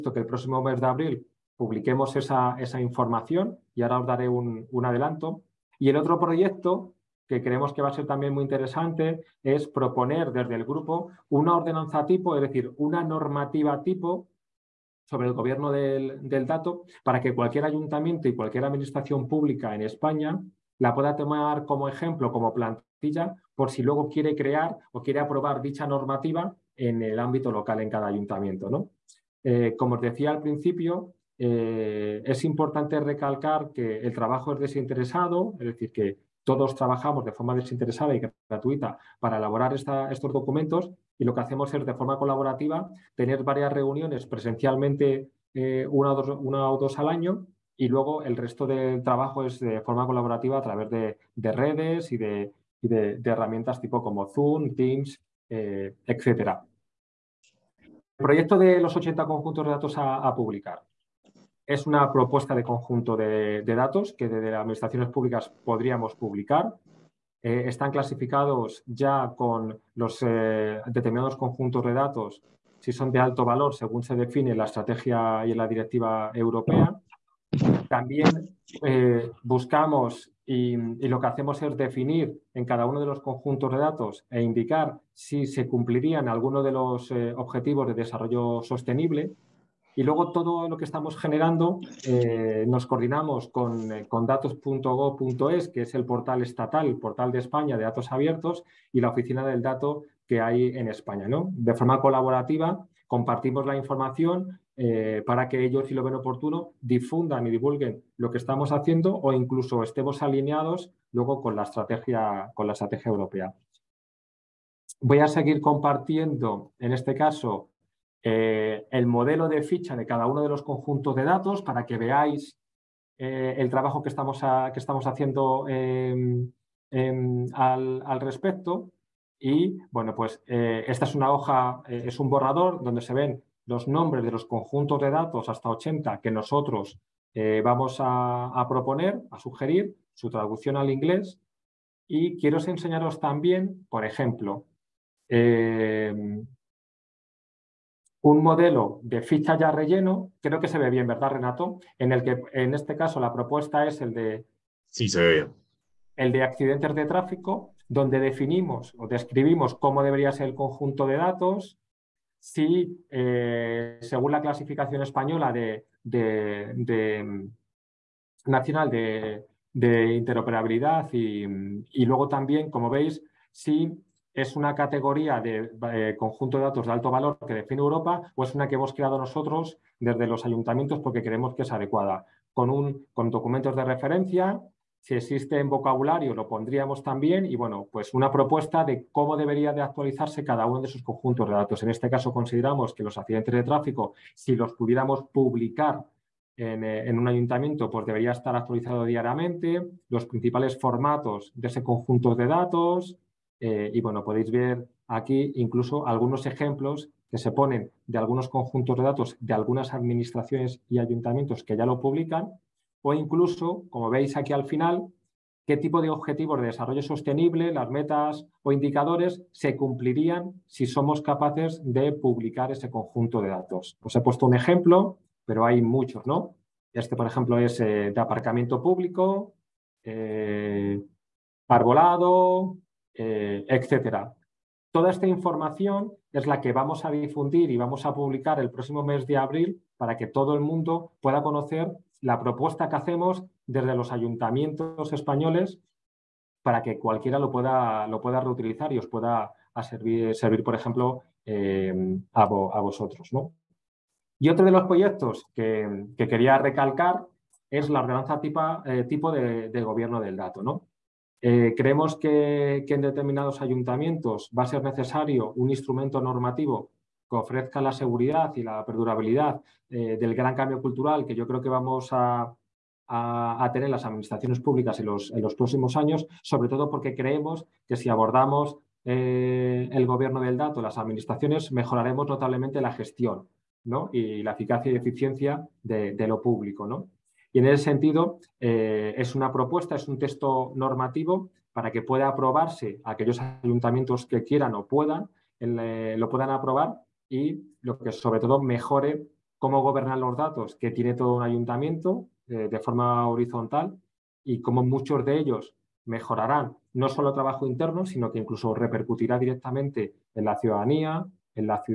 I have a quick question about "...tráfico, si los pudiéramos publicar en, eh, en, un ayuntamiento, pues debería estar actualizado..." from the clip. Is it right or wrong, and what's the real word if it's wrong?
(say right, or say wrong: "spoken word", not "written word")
right.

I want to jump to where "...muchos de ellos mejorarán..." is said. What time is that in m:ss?
5:04.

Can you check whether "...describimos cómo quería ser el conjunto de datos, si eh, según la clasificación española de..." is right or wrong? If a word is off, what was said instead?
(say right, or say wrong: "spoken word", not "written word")
wrong: "debería", not "quería".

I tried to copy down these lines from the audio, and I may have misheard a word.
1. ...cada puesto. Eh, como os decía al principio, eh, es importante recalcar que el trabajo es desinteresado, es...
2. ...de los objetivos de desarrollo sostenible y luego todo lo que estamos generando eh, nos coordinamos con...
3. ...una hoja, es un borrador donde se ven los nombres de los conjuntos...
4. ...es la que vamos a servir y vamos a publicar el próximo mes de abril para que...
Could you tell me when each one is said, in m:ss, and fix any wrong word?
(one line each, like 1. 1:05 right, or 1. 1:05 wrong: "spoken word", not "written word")
1. 0:27 wrong: "ayuntamiento", not "puesto"
2. 1:26 right
3. 2:11 right
4. 3:56 wrong: "difundir", not "servir".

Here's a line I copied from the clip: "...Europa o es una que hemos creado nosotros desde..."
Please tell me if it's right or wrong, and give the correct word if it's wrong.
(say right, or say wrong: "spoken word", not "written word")
right.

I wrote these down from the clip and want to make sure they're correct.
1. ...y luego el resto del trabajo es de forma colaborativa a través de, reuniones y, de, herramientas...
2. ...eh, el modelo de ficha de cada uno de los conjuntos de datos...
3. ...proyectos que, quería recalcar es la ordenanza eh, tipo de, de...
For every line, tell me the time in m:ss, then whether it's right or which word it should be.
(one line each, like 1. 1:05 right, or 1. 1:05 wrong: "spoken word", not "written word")
1. 0:47 wrong: "redes", not "reuniones"
2. 1:58 right
3. 4:14 right.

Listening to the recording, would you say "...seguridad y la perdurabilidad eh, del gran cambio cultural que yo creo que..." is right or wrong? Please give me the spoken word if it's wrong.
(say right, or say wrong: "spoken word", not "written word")
right.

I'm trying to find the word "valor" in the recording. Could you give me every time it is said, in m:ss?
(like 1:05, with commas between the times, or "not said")
1:13, 2:57.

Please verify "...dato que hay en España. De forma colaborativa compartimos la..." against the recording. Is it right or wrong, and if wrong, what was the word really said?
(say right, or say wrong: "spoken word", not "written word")
right.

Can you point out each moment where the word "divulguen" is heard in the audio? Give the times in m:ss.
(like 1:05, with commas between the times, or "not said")
1:47.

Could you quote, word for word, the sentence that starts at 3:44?
Os he puesto un ejemplo, pero hay muchos, ¿no?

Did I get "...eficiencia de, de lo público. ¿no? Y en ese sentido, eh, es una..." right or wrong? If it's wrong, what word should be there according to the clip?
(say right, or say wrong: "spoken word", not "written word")
right.